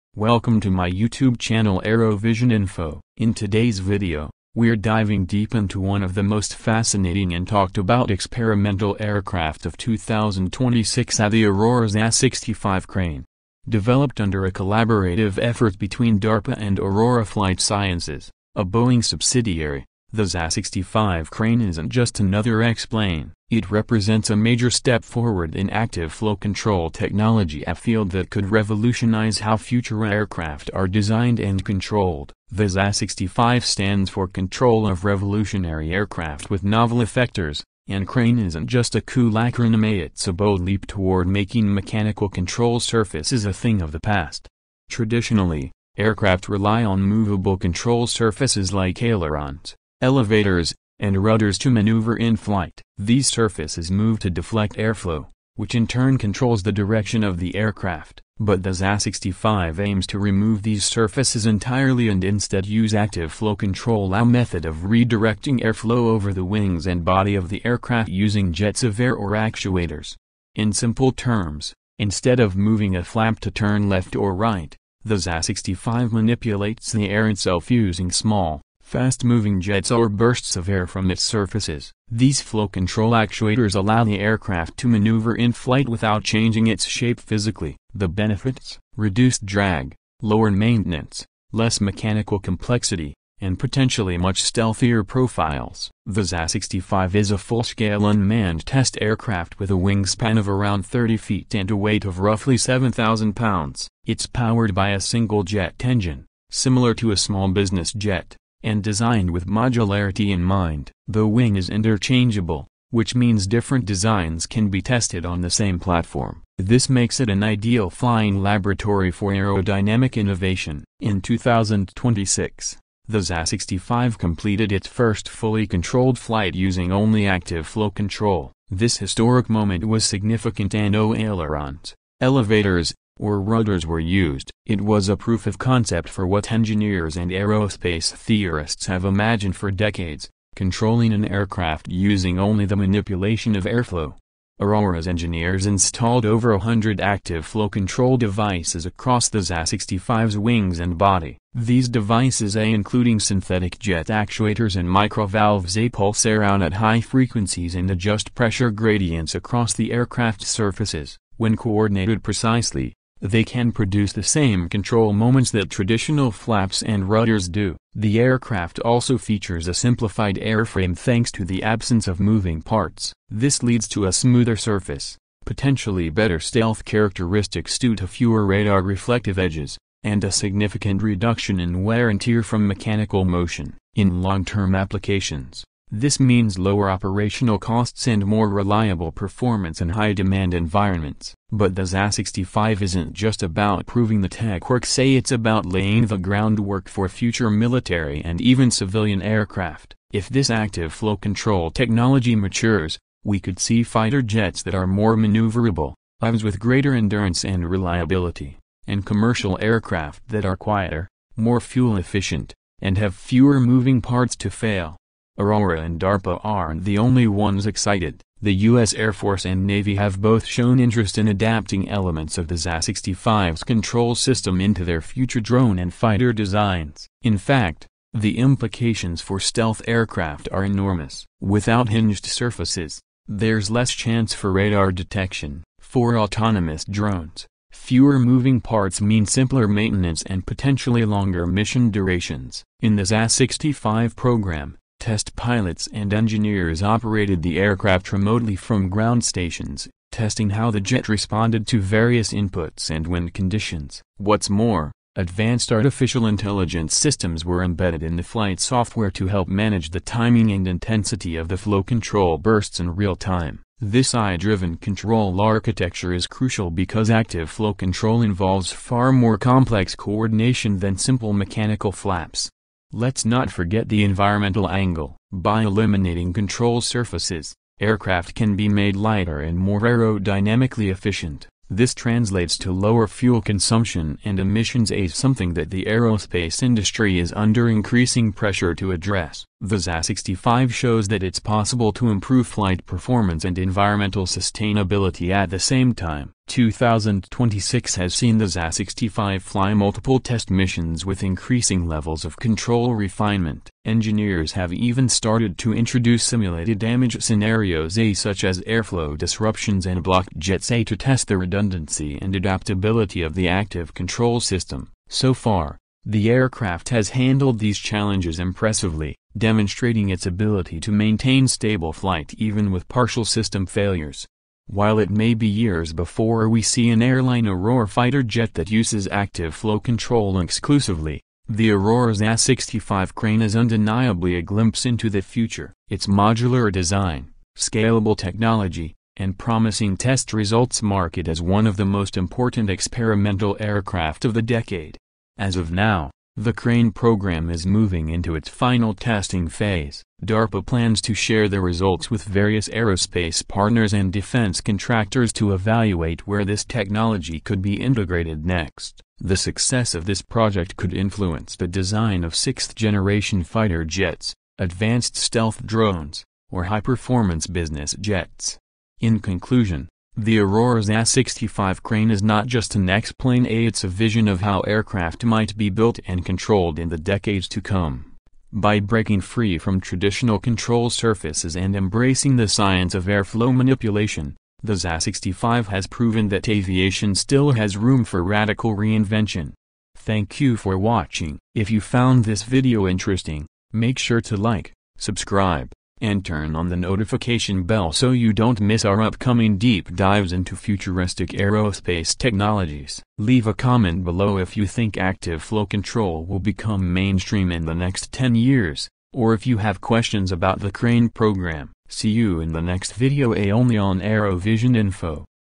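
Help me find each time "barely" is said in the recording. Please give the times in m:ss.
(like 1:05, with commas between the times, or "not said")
not said.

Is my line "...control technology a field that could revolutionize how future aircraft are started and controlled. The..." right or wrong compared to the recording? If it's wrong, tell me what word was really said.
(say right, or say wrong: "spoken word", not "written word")
wrong: "designed", not "started".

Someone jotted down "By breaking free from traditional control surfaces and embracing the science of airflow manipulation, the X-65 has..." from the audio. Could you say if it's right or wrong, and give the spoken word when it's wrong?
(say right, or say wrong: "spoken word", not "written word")
right.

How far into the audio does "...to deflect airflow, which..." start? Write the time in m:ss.
0:54.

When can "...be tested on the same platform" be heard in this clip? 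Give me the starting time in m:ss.
1:54.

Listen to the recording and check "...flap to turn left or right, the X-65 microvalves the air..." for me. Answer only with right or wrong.
wrong.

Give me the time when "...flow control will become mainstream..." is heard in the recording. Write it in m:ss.
6:45.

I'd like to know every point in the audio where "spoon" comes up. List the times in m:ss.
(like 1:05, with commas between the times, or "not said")
not said.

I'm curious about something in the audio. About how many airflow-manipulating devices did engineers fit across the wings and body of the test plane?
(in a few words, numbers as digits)
over 100.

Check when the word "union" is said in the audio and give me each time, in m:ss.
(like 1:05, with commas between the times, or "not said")
not said.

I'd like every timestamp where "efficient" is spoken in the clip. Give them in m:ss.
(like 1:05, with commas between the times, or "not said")
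3:31, 4:40.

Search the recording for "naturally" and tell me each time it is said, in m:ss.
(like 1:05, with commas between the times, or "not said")
not said.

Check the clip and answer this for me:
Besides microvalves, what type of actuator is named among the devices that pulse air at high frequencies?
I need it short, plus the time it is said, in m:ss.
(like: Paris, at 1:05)
synthetic jet actuators, at 2:33.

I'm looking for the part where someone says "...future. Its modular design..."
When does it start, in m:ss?
5:35.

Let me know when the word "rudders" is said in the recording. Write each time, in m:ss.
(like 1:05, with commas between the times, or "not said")
0:51, 2:13, 2:47.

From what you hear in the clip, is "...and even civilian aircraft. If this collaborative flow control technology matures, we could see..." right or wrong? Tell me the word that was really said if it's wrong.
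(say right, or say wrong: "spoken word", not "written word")
wrong: "active", not "collaborative".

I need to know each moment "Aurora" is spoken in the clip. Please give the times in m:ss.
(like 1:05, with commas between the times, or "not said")
0:11, 0:16, 2:24, 3:35, 5:27, 5:31, 6:10.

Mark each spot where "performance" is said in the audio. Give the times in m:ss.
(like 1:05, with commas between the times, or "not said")
3:09, 4:52, 6:06.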